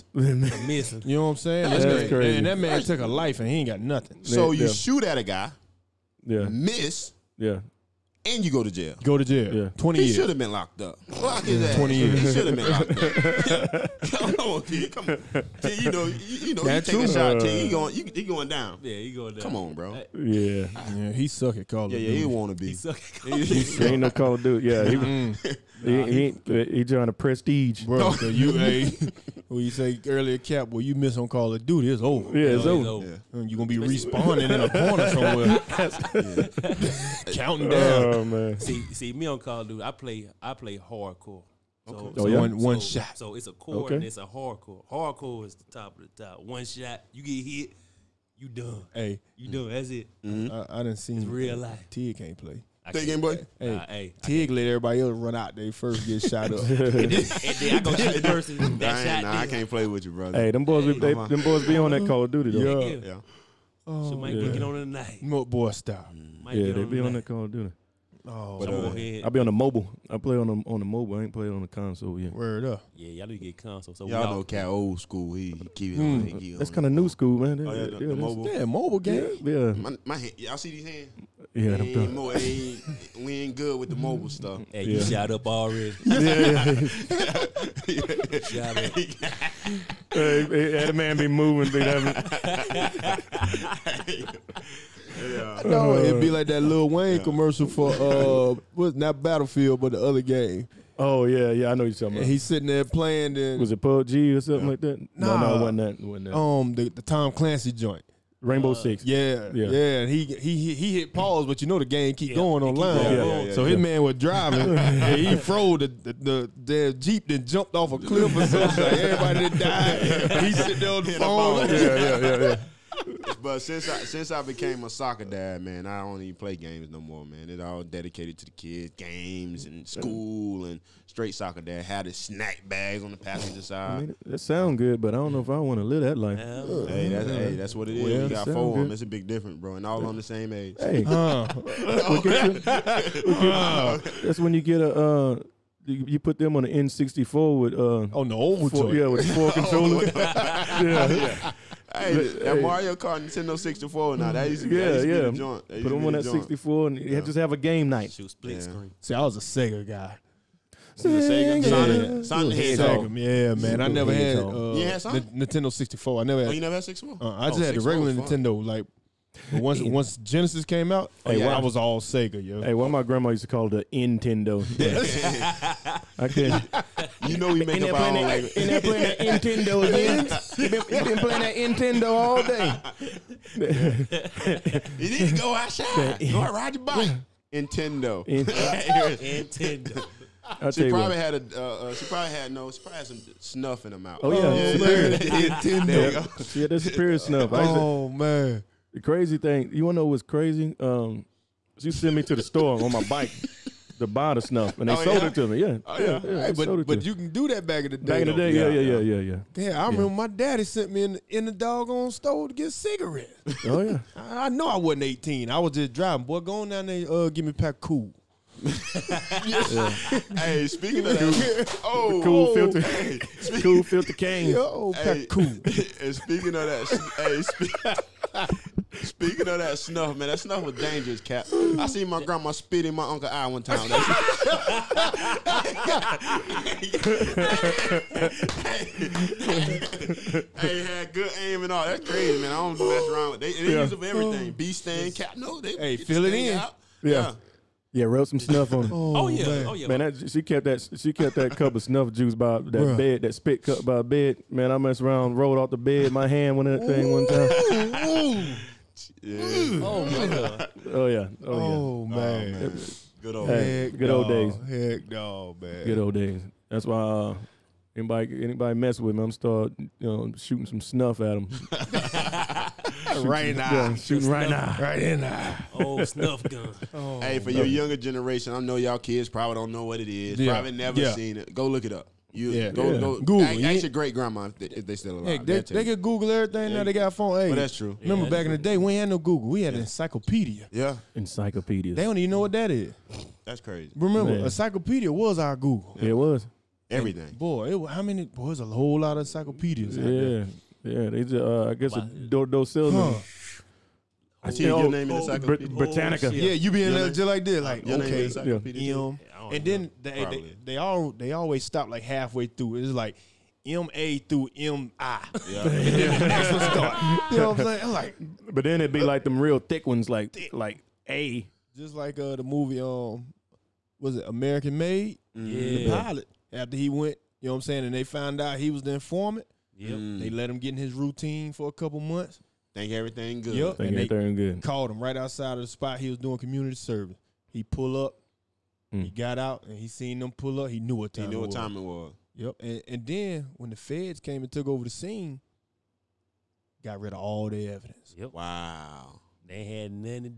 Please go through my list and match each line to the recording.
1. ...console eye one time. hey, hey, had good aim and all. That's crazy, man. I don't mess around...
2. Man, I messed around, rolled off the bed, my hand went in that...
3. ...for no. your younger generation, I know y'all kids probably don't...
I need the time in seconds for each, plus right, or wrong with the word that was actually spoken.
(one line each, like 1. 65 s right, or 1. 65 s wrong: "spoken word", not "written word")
1. 233 s wrong: "uncle", not "console"
2. 254 s right
3. 277 s right.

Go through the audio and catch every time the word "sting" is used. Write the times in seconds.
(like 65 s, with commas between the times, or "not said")
244 s.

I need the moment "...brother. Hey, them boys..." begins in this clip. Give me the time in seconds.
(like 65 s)
60 s.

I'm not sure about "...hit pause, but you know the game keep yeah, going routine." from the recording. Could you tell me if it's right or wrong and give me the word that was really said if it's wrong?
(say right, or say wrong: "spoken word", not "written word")
wrong: "online", not "routine".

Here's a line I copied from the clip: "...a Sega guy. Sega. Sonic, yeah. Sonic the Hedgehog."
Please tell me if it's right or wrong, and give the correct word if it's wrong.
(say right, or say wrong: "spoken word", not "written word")
right.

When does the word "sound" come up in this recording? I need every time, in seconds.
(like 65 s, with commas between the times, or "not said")
134 s.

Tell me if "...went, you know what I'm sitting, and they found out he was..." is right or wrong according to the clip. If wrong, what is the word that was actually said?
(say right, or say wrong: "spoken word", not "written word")
wrong: "saying", not "sitting".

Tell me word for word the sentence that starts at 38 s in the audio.
Oh man, See, see, me on Call of Duty, I play, I play hardcore.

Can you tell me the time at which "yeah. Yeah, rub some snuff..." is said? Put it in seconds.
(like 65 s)
247 s.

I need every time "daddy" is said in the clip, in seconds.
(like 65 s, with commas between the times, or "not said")
210 s.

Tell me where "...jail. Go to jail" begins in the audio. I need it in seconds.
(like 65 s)
8 s.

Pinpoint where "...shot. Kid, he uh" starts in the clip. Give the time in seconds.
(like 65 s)
17 s.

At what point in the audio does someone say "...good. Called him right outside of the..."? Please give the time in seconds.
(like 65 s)
334 s.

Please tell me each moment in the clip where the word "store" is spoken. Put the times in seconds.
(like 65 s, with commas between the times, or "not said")
202 s, 212 s.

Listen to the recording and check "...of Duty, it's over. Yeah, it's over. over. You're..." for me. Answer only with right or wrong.
right.